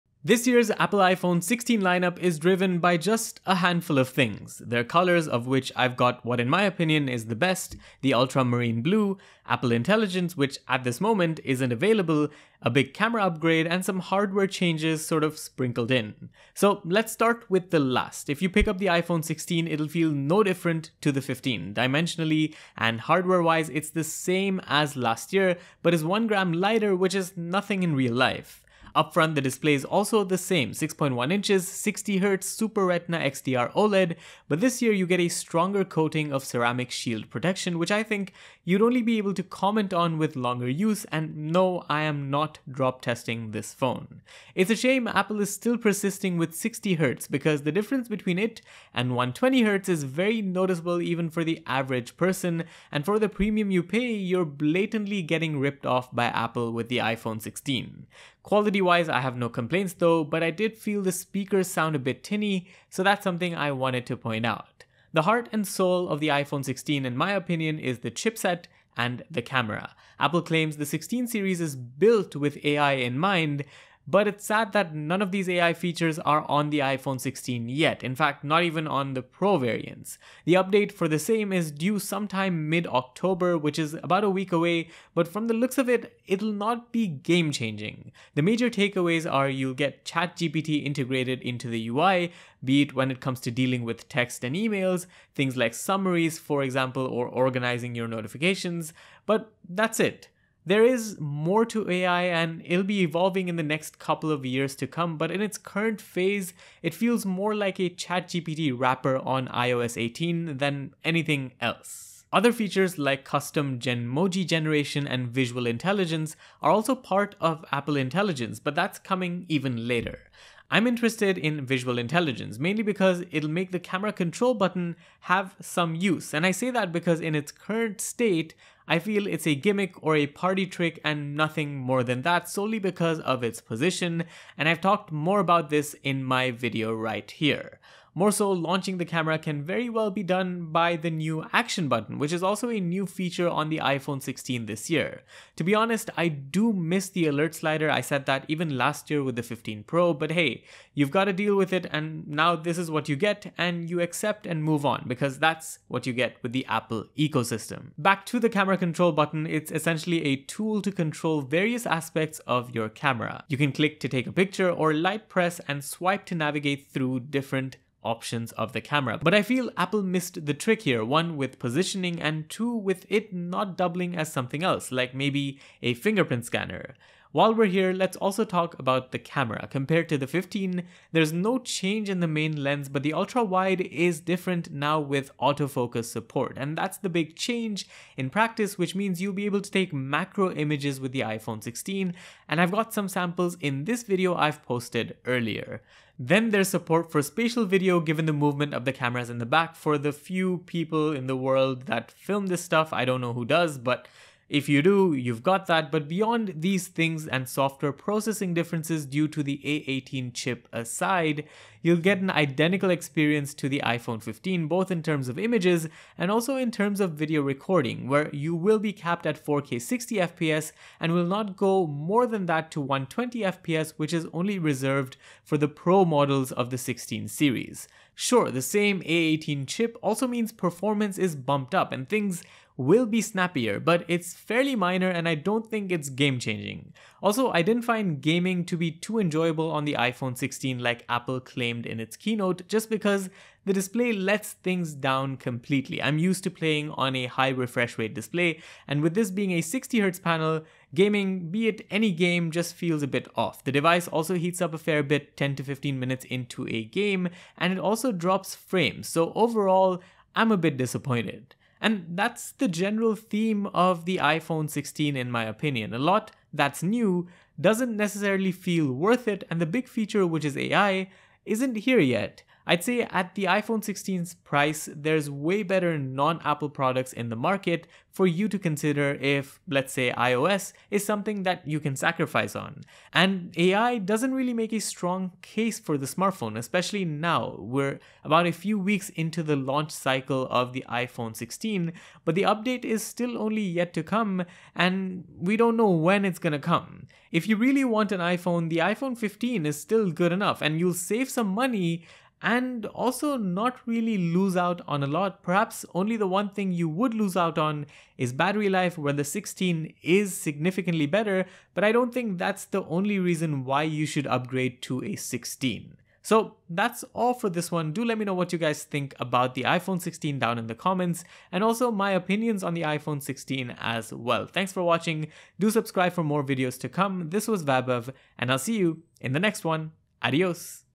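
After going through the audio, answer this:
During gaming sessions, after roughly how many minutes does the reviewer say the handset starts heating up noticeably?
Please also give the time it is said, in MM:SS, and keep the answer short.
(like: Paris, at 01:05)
10 to 15 minutes, at 04:15.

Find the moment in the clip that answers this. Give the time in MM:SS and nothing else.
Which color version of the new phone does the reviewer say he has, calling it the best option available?
00:08.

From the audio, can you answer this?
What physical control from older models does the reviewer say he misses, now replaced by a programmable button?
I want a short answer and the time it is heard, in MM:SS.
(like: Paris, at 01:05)
alert slider, at 02:27.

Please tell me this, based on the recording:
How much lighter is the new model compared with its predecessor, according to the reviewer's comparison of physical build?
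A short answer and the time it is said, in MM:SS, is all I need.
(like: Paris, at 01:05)
1 gram, at 00:26.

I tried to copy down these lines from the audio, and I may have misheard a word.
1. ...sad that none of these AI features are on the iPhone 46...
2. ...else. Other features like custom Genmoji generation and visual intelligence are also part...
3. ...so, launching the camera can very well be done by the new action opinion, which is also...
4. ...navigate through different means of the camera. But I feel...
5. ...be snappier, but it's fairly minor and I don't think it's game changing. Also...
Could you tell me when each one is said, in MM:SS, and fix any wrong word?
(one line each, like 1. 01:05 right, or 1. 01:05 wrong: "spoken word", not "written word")
1. 01:14 wrong: "16", not "46"
2. 01:51 right
3. 02:18 wrong: "button", not "opinion"
4. 02:46 wrong: "options", not "means"
5. 03:53 right.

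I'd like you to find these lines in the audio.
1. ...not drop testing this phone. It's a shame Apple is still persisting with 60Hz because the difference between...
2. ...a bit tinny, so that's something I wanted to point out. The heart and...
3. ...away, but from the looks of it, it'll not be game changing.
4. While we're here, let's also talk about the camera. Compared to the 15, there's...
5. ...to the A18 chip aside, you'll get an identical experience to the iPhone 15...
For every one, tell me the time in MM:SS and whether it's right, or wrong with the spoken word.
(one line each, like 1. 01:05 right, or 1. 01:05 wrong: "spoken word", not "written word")
1. 00:42 right
2. 01:01 right
3. 01:24 right
4. 02:57 right
5. 03:29 right.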